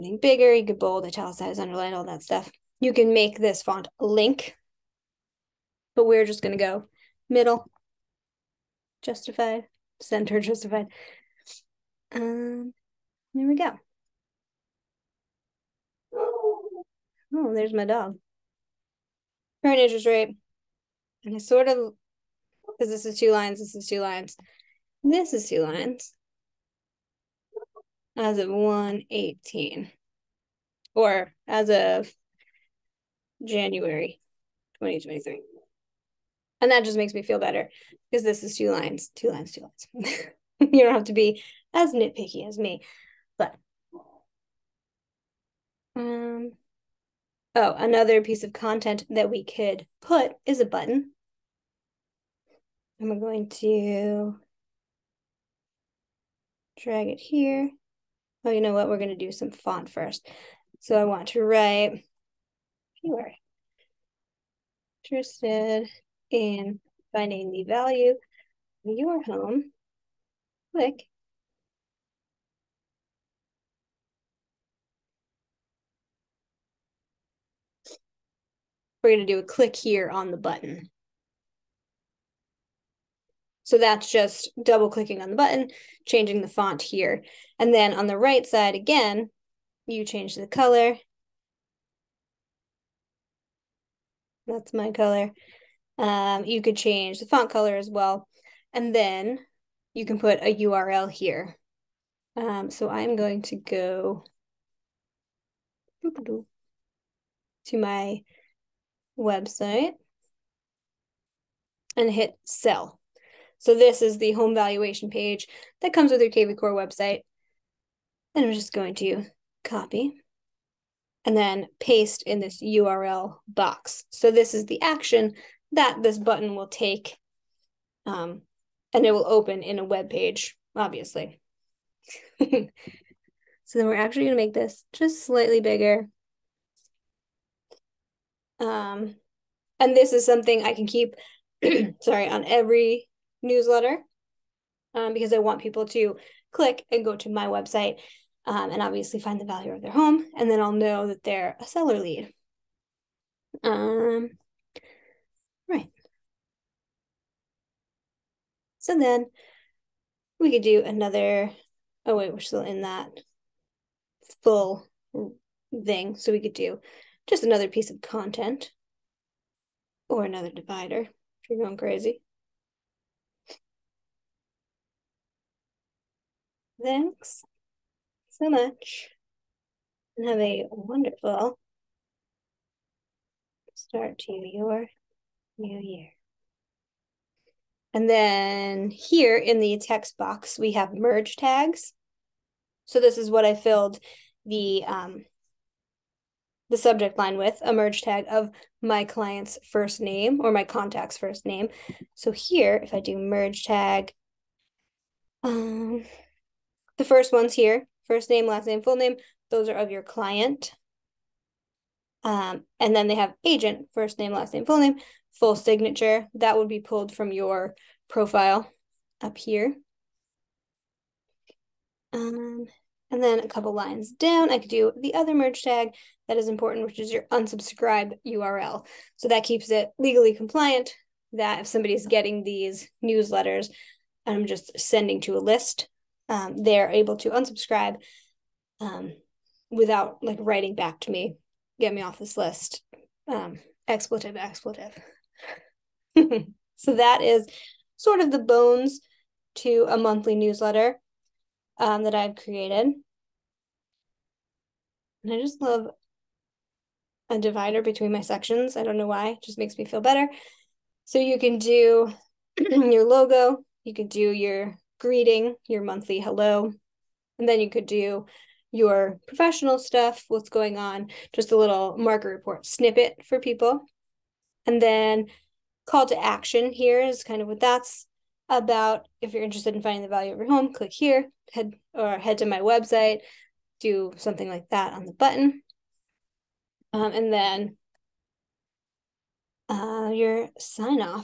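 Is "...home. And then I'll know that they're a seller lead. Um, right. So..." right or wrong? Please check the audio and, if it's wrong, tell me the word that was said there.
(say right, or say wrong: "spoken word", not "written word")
right.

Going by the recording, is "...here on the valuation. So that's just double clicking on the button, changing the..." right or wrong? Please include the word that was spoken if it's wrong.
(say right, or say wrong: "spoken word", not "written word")
wrong: "button", not "valuation".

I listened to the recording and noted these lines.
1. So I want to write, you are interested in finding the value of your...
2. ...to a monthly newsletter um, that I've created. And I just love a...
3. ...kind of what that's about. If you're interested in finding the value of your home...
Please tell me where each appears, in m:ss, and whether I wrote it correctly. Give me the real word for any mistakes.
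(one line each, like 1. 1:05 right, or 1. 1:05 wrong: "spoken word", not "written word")
1. 1:00 right
2. 4:09 right
3. 4:37 right.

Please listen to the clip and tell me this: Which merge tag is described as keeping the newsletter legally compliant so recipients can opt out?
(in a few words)
unsubscribe URL.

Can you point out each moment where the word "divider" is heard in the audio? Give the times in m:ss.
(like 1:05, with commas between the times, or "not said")
2:50, 4:17.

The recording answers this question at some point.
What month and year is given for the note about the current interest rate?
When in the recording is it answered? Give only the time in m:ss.
0:33.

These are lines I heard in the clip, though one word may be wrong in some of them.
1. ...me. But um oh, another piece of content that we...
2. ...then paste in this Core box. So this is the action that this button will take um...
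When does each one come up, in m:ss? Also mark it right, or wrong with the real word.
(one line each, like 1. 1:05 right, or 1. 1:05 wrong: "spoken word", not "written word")
1. 0:42 right
2. 2:01 wrong: "URL", not "Core".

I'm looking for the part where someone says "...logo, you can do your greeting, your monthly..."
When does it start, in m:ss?
4:23.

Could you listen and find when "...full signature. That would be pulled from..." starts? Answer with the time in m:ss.
3:35.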